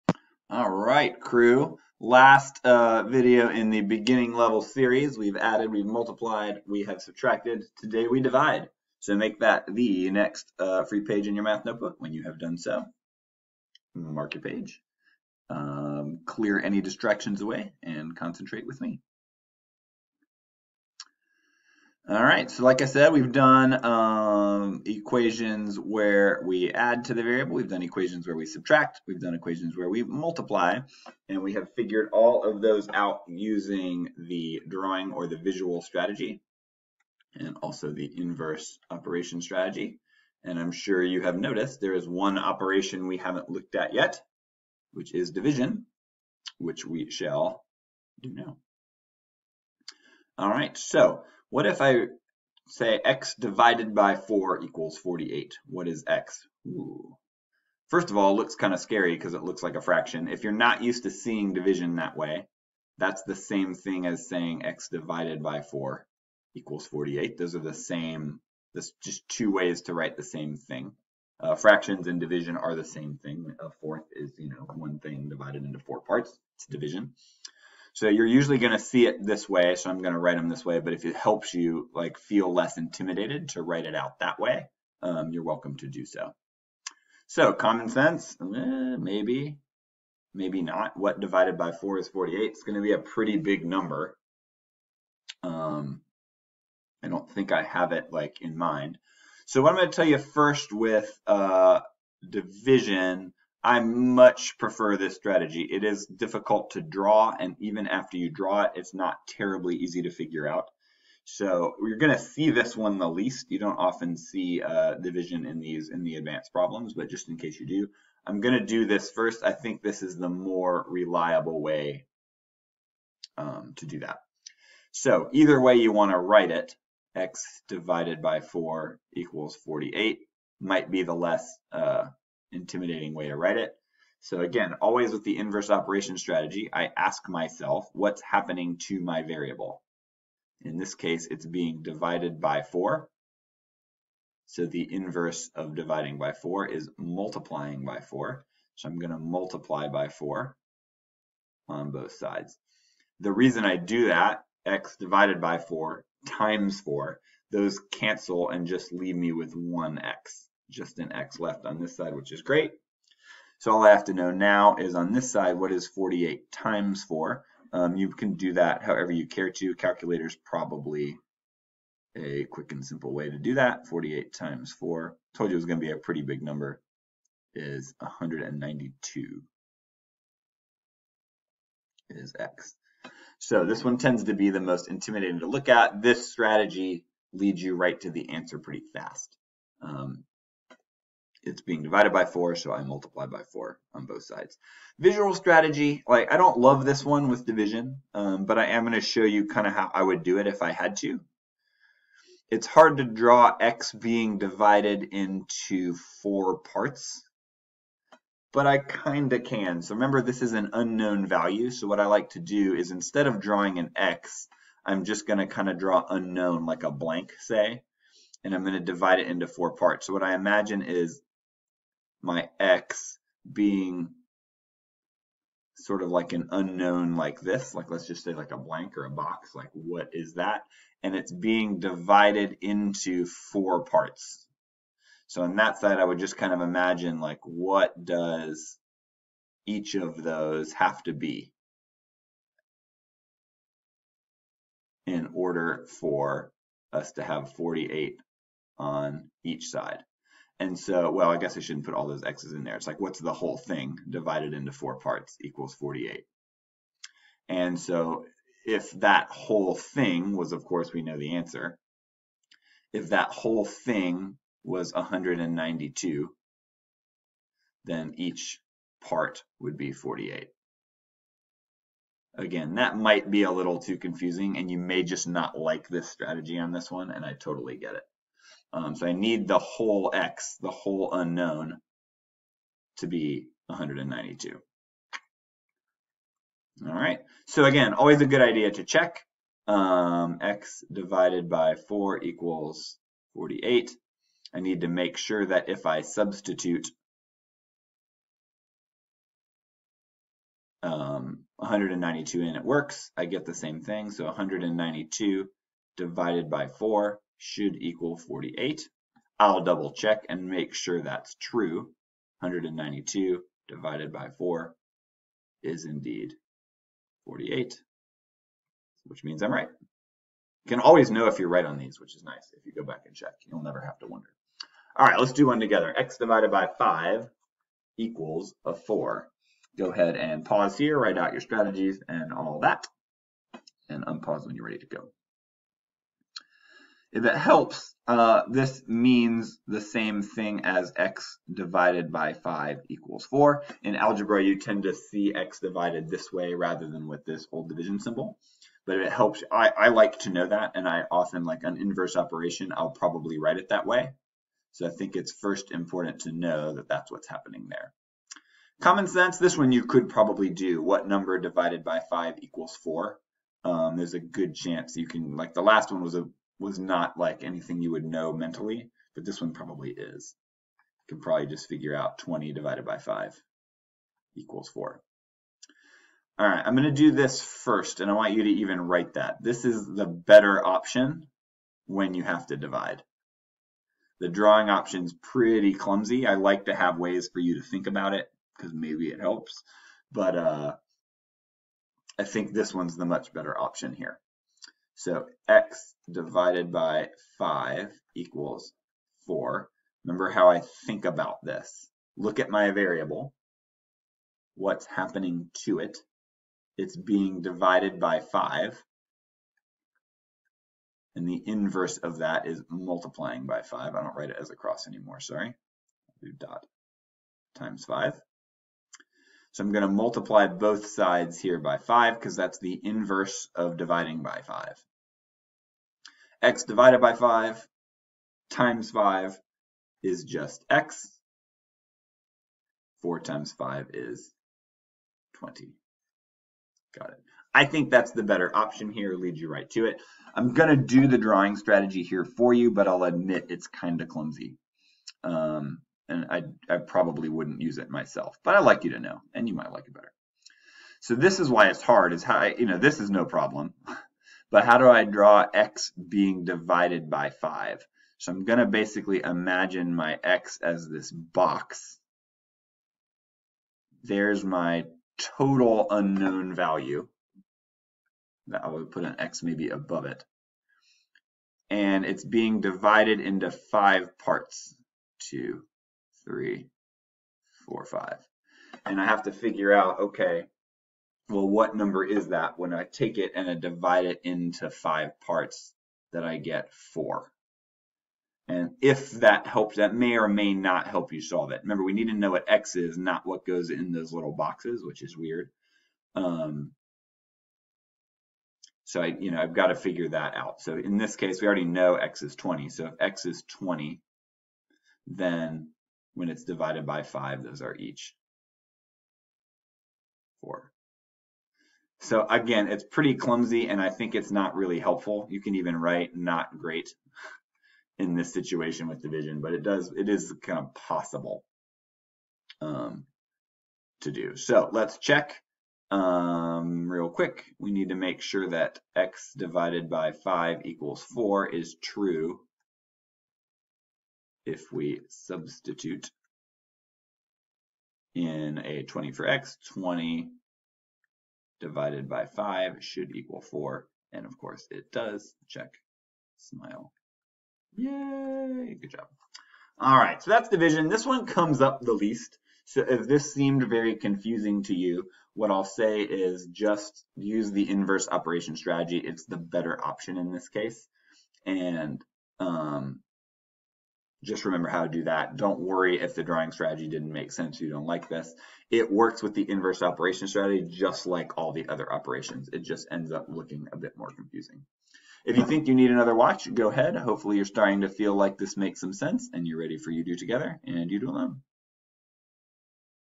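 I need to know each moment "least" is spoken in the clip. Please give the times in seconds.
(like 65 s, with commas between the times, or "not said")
113 s, 551 s.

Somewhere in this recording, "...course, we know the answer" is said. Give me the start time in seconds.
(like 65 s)
260 s.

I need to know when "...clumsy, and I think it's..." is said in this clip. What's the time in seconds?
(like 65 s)
513 s.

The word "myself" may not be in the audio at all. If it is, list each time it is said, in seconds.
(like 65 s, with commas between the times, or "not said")
137 s, 447 s.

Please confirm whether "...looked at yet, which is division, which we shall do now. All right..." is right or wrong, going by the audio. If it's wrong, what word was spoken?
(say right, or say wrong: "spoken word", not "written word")
right.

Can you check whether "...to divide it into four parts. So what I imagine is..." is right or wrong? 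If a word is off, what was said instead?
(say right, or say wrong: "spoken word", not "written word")
right.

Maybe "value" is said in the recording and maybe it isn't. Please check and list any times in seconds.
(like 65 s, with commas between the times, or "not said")
211 s, 466 s.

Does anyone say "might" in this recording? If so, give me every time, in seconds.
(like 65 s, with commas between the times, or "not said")
130 s, 272 s, 449 s.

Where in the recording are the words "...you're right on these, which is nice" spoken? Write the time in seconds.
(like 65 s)
321 s.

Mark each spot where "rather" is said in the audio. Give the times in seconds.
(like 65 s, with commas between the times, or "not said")
346 s.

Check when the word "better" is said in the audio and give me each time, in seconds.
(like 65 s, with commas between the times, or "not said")
380 s, 393 s, 438 s, 449 s, 559 s.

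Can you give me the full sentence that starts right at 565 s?
Don't worry if the drawing strategy didn't make sense, you don't like this.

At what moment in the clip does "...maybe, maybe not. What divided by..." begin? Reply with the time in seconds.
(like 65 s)
88 s.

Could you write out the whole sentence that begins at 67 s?
Those are the same, there's just two ways to write the same thing.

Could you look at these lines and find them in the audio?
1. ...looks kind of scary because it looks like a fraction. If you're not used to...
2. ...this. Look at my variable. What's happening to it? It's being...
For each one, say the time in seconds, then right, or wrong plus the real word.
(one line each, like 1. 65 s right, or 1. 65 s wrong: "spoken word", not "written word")
1. 58 s right
2. 401 s right.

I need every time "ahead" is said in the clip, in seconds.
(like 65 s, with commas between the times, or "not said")
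329 s, 576 s.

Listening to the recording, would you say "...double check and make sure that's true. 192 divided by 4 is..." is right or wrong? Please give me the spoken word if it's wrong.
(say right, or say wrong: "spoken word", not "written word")
right.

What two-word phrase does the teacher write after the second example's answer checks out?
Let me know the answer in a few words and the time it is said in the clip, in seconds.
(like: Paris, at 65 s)
Check, smile, at 545 s.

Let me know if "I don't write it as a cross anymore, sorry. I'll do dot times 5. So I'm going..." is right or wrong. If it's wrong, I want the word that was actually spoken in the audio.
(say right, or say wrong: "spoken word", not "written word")
right.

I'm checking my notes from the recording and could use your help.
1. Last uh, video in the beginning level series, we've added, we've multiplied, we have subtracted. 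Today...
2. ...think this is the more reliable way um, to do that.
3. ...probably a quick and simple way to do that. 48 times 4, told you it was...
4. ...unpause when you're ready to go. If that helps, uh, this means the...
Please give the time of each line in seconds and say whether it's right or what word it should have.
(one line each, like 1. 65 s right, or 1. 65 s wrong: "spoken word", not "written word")
1. 2 s right
2. 119 s right
3. 170 s right
4. 334 s right.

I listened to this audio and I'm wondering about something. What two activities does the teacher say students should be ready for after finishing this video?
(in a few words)
You Do Together and You Do Alone.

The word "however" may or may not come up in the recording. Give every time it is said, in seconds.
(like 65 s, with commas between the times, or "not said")
168 s.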